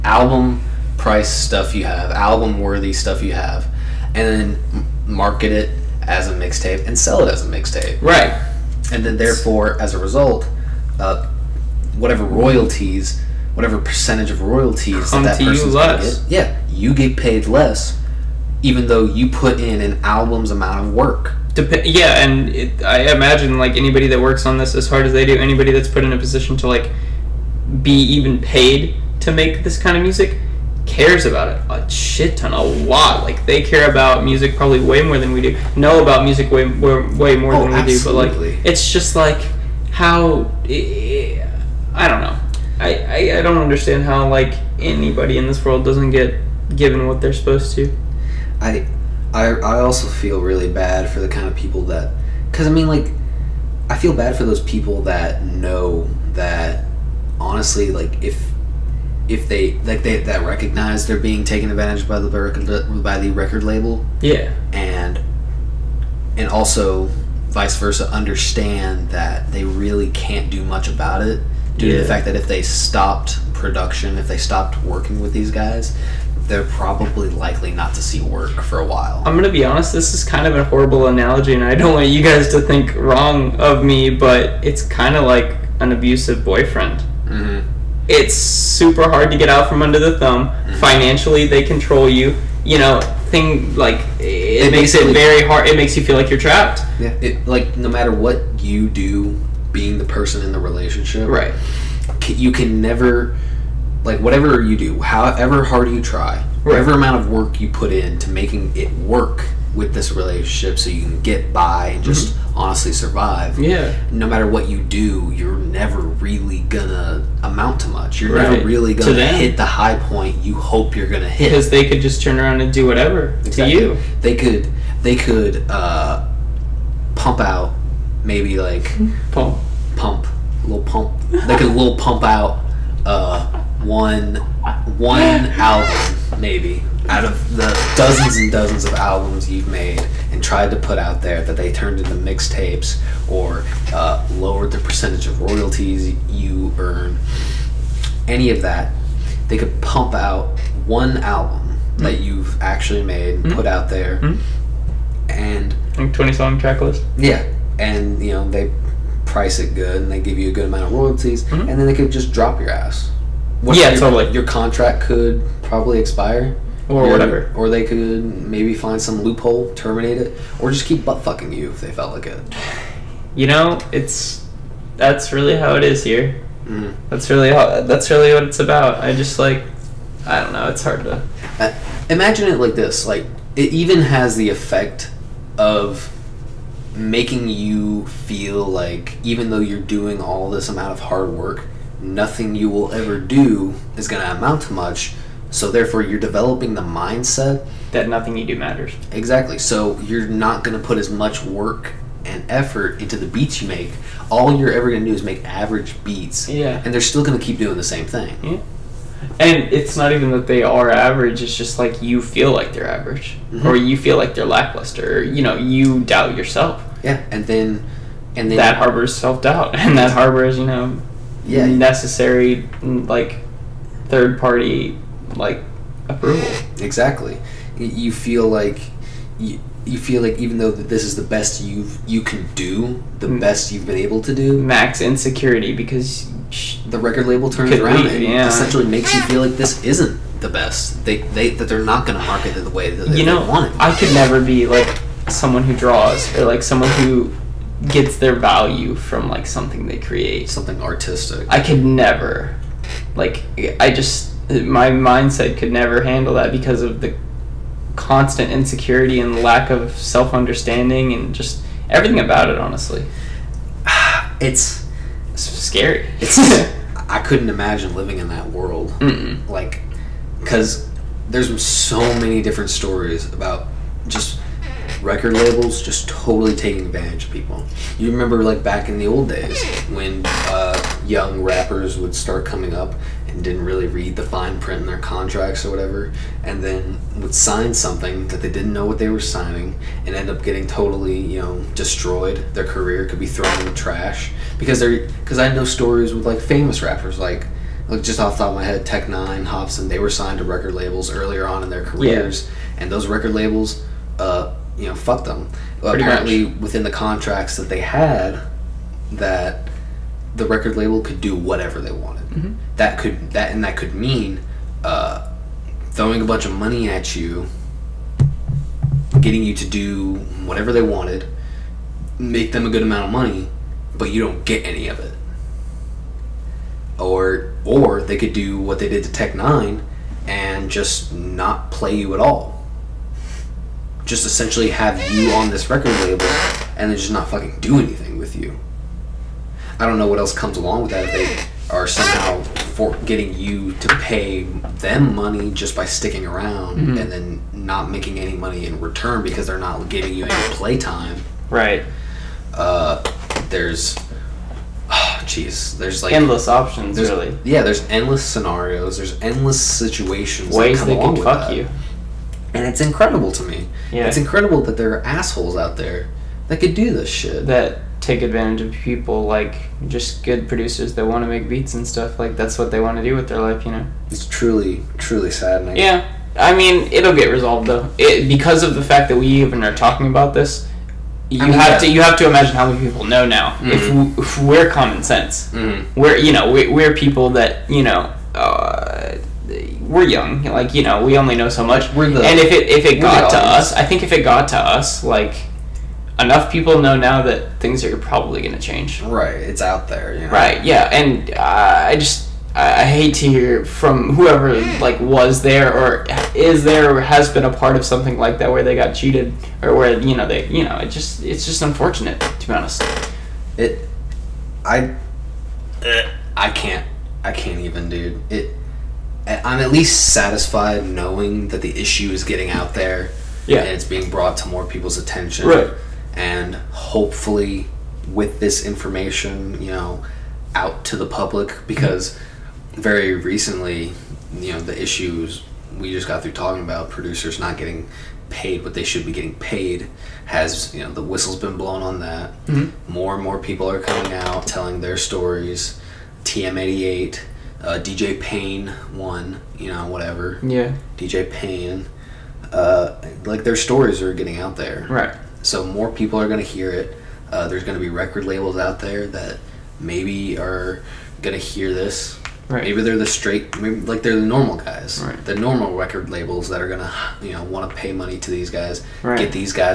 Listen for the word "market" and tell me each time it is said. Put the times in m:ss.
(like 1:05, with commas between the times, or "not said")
0:05, 4:02.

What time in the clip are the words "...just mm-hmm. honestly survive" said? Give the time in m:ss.
1:52.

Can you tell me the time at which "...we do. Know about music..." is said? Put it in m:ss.
0:35.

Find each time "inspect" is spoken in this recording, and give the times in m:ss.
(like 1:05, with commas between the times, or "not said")
not said.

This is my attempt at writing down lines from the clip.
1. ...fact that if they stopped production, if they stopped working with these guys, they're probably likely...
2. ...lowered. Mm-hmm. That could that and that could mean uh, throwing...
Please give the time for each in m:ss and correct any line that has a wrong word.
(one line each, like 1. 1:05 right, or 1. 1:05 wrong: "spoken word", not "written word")
1. 1:12 right
2. 5:11 wrong: "wanted", not "lowered".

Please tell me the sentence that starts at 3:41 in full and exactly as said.
necessary like third party like approval.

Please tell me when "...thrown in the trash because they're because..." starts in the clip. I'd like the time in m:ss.
4:53.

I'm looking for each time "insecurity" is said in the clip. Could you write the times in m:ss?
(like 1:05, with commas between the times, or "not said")
3:54, 4:18.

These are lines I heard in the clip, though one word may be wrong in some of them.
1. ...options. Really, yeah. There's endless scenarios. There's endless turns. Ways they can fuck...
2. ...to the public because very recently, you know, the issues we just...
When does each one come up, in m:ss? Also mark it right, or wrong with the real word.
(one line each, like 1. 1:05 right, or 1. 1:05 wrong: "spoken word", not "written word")
1. 5:56 wrong: "situations", not "turns"
2. 7:10 right.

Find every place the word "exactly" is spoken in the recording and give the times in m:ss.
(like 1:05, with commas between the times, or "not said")
2:03, 3:19, 3:46.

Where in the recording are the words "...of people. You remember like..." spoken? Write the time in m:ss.
4:37.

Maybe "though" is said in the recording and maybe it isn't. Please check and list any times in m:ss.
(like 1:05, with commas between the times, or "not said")
0:18, 3:09, 3:50, 6:17.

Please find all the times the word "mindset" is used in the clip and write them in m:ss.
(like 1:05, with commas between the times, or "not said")
3:16, 4:14.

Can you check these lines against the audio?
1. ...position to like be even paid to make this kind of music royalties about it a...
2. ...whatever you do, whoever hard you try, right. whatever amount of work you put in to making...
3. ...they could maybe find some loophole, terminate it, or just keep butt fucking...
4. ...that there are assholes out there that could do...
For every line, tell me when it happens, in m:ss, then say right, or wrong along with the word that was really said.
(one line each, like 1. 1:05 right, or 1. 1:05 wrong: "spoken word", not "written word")
1. 0:26 wrong: "cares", not "royalties"
2. 1:44 wrong: "however", not "whoever"
3. 2:47 right
4. 6:04 right.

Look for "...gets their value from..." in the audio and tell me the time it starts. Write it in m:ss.
4:07.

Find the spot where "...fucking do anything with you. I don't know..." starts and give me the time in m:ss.
5:37.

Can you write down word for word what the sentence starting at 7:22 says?
more and more people are coming out telling their stories TM88 uh, DJ Pain 1, you know, whatever.